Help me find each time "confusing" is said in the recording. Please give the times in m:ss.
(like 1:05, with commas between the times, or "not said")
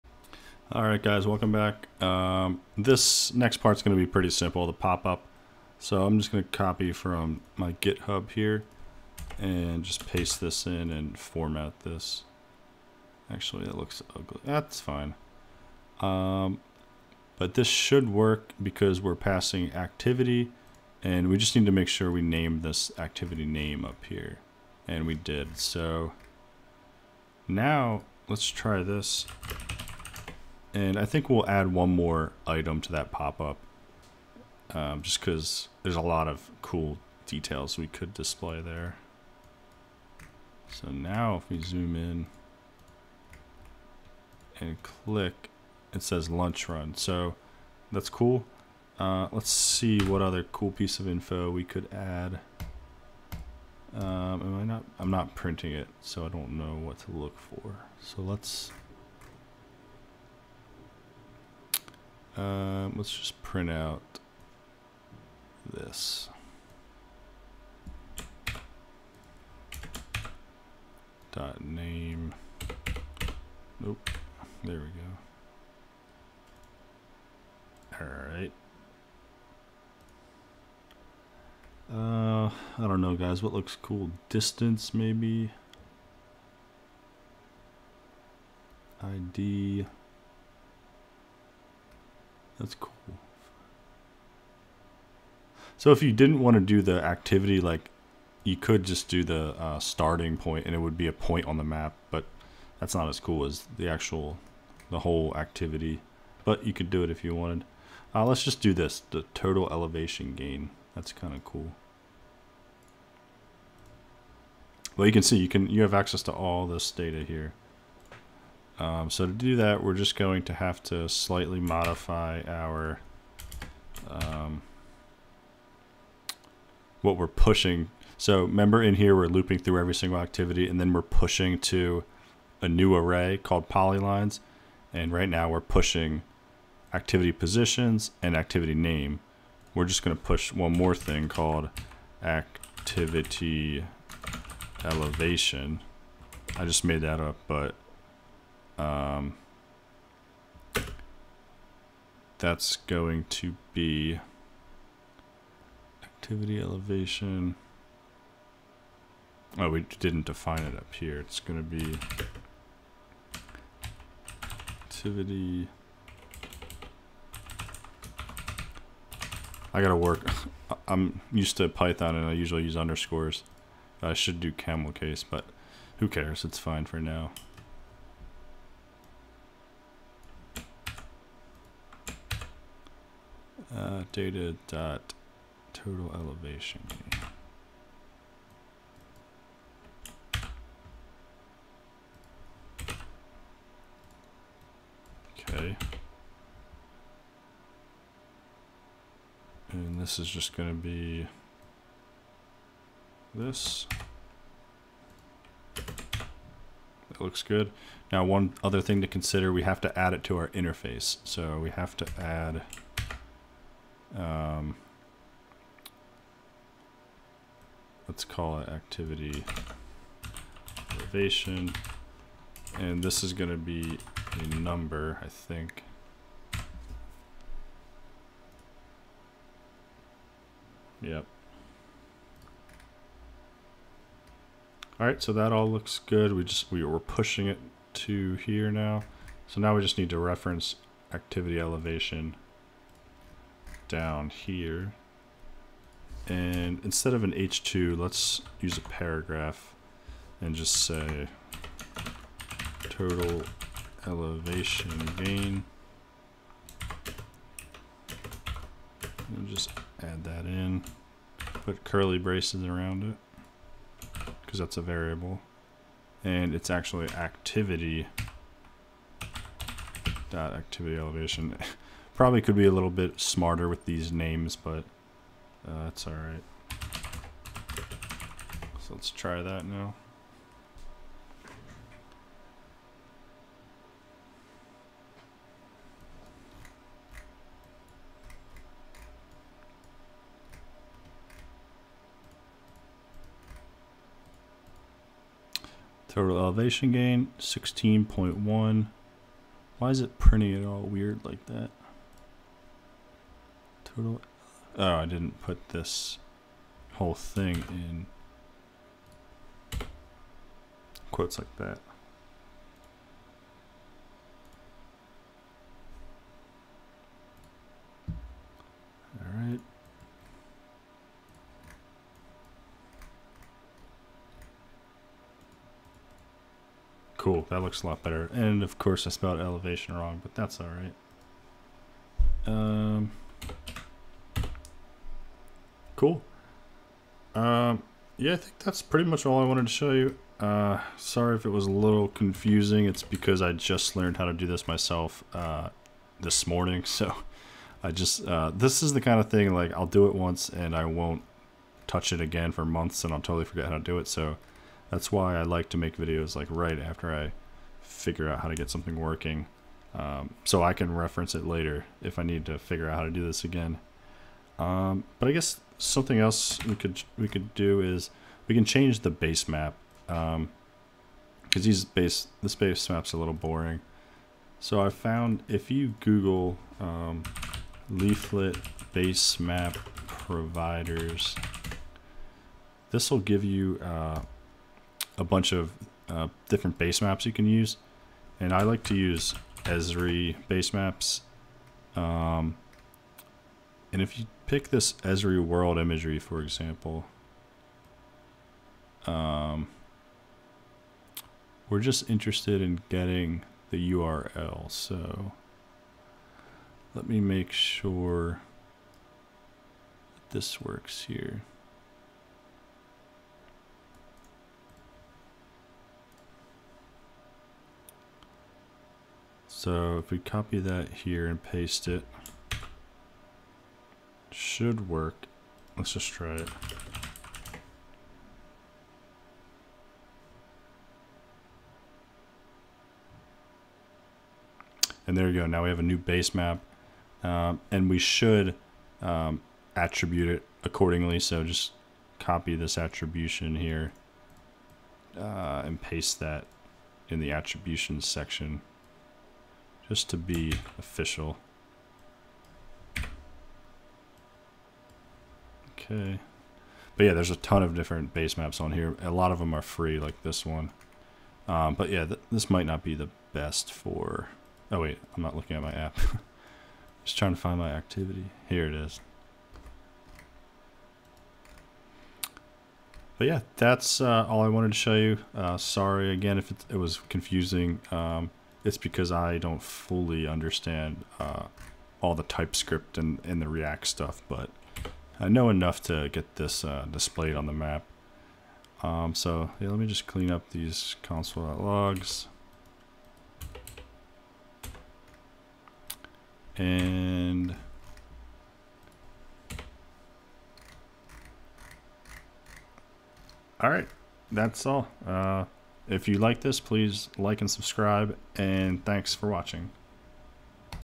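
5:42, 7:57.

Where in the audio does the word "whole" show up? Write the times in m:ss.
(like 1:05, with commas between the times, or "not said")
1:44, 5:06.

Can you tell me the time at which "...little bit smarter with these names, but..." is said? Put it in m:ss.
4:32.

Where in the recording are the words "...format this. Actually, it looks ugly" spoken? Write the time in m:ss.
0:11.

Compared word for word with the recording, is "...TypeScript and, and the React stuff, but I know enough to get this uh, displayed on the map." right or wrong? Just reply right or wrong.
right.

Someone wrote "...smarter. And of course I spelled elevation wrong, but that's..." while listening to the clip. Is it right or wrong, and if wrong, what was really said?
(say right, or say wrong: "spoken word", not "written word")
wrong: "better", not "smarter".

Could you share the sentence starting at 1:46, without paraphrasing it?
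But you could do it if you wanted.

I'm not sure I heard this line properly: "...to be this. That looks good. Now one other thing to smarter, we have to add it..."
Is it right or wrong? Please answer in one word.
wrong.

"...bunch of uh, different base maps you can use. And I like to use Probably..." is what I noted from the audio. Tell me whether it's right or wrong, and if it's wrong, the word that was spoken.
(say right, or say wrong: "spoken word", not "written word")
wrong: "Esri", not "Probably".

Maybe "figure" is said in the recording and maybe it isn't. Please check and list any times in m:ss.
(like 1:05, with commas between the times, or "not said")
5:57, 6:02.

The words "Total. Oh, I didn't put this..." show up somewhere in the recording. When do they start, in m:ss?
5:03.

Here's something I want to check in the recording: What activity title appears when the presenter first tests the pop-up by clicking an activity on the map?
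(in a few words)
Lunch Run.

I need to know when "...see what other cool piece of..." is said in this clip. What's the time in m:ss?
0:49.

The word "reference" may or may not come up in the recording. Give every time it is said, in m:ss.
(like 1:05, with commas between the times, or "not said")
4:00, 6:00.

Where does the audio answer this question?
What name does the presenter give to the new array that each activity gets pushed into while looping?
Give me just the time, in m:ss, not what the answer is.
2:13.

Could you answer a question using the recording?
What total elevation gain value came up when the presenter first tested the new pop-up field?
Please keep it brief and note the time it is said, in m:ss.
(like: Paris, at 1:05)
16.1, at 4:57.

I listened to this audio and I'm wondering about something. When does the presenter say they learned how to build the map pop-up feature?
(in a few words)
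this morning.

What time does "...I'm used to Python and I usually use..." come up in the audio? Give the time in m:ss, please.
2:50.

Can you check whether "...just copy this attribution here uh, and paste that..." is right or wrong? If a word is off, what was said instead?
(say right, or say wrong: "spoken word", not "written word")
right.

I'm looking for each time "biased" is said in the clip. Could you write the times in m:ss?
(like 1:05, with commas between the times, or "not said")
not said.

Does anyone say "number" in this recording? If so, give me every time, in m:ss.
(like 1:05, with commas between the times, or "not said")
3:44.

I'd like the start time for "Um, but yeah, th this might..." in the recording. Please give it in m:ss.
7:41.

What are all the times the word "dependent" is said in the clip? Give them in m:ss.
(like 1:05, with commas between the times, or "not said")
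not said.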